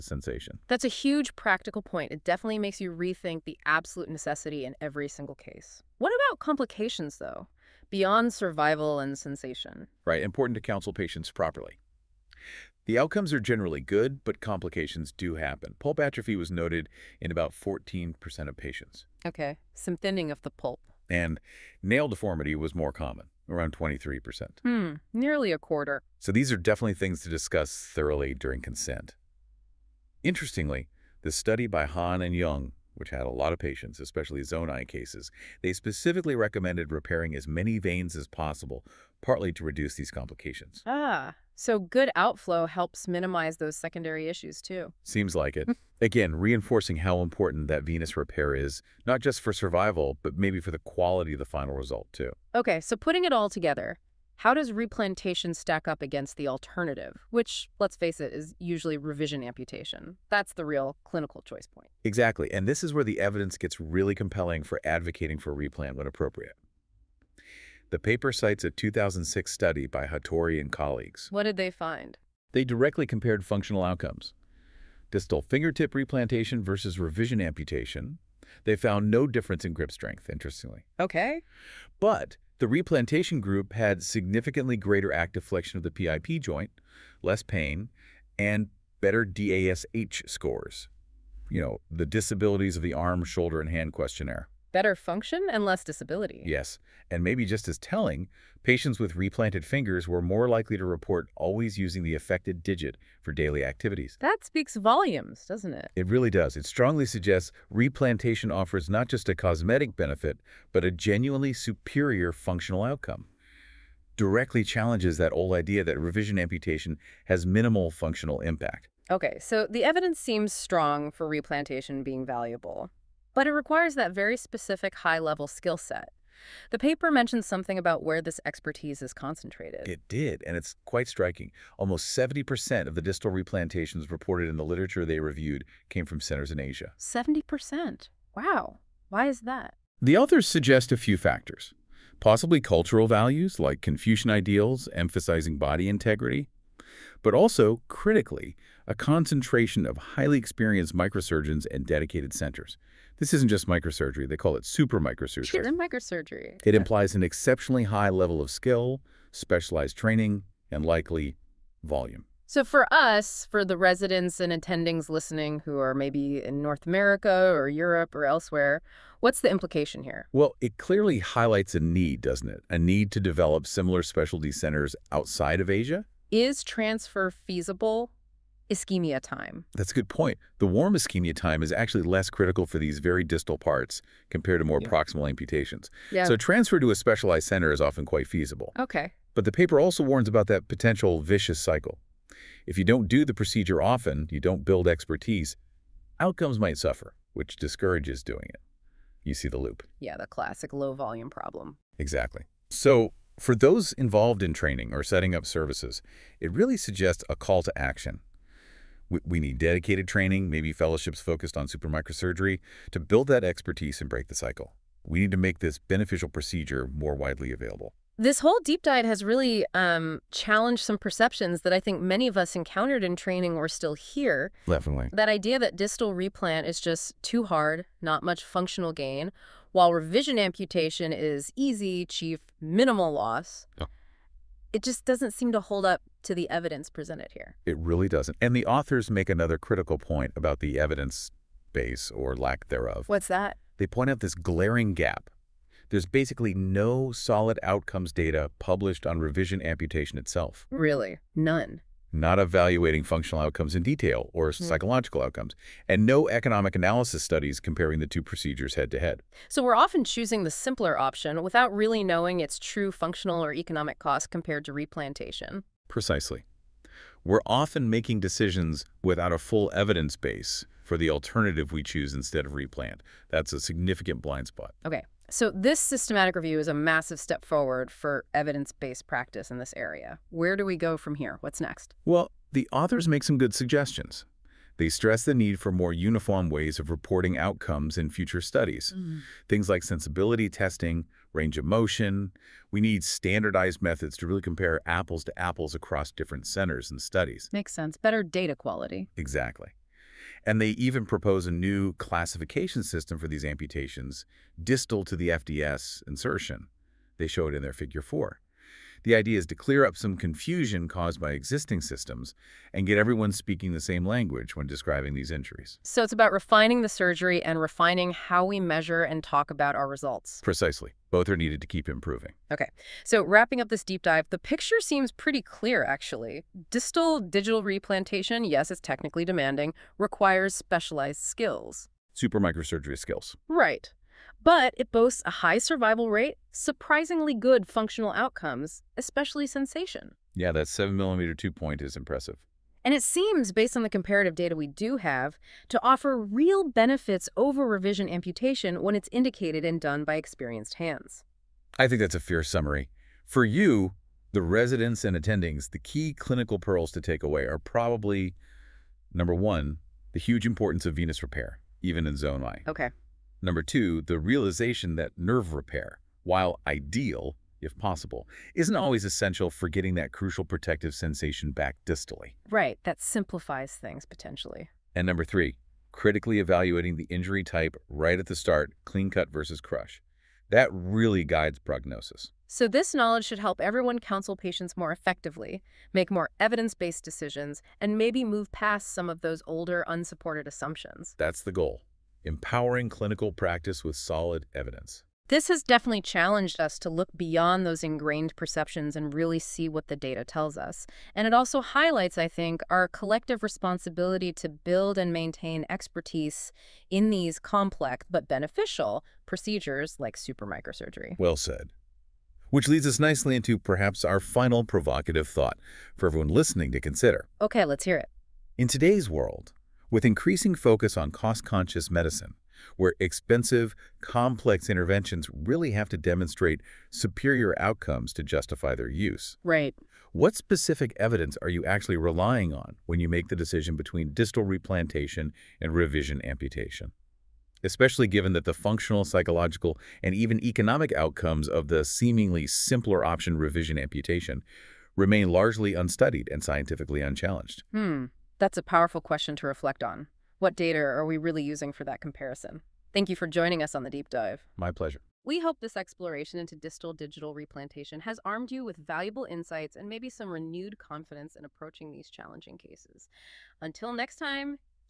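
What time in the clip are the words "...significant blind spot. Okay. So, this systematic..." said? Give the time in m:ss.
4:33.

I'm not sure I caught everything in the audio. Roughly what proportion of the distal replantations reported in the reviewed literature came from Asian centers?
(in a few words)
70%.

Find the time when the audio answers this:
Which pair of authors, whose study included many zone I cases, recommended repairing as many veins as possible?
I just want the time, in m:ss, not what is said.
0:31.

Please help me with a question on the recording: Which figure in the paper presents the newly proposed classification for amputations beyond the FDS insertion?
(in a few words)
Figure 4.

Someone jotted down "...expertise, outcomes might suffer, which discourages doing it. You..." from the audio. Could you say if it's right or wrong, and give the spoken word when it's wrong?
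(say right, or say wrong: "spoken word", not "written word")
right.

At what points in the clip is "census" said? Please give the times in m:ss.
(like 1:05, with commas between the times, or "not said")
not said.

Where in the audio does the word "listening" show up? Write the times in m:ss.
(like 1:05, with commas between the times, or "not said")
2:45, 6:56.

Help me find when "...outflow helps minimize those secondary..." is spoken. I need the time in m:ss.
0:42.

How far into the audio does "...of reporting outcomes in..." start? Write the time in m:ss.
4:46.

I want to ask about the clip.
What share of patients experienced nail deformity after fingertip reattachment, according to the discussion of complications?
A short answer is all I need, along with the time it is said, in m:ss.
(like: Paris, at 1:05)
23%, at 0:23.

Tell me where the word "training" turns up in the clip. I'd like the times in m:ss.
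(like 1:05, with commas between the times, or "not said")
2:39, 3:24, 3:30, 3:43.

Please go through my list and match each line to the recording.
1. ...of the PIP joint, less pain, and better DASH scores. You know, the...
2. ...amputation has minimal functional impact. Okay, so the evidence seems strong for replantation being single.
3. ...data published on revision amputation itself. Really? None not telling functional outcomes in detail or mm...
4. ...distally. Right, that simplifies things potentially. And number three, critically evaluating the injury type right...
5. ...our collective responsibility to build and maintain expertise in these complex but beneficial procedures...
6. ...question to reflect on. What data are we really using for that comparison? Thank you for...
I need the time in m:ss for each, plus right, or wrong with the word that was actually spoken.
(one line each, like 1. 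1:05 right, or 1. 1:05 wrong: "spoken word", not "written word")
1. 1:25 right
2. 1:56 wrong: "valuable", not "single"
3. 4:08 wrong: "evaluating", not "telling"
4. 6:11 right
5. 6:42 right
6. 7:29 right.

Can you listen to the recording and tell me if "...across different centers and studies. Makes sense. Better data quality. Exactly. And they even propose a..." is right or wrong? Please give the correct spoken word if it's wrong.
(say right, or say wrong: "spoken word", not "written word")
right.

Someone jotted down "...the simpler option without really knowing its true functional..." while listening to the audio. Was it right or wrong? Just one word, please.
right.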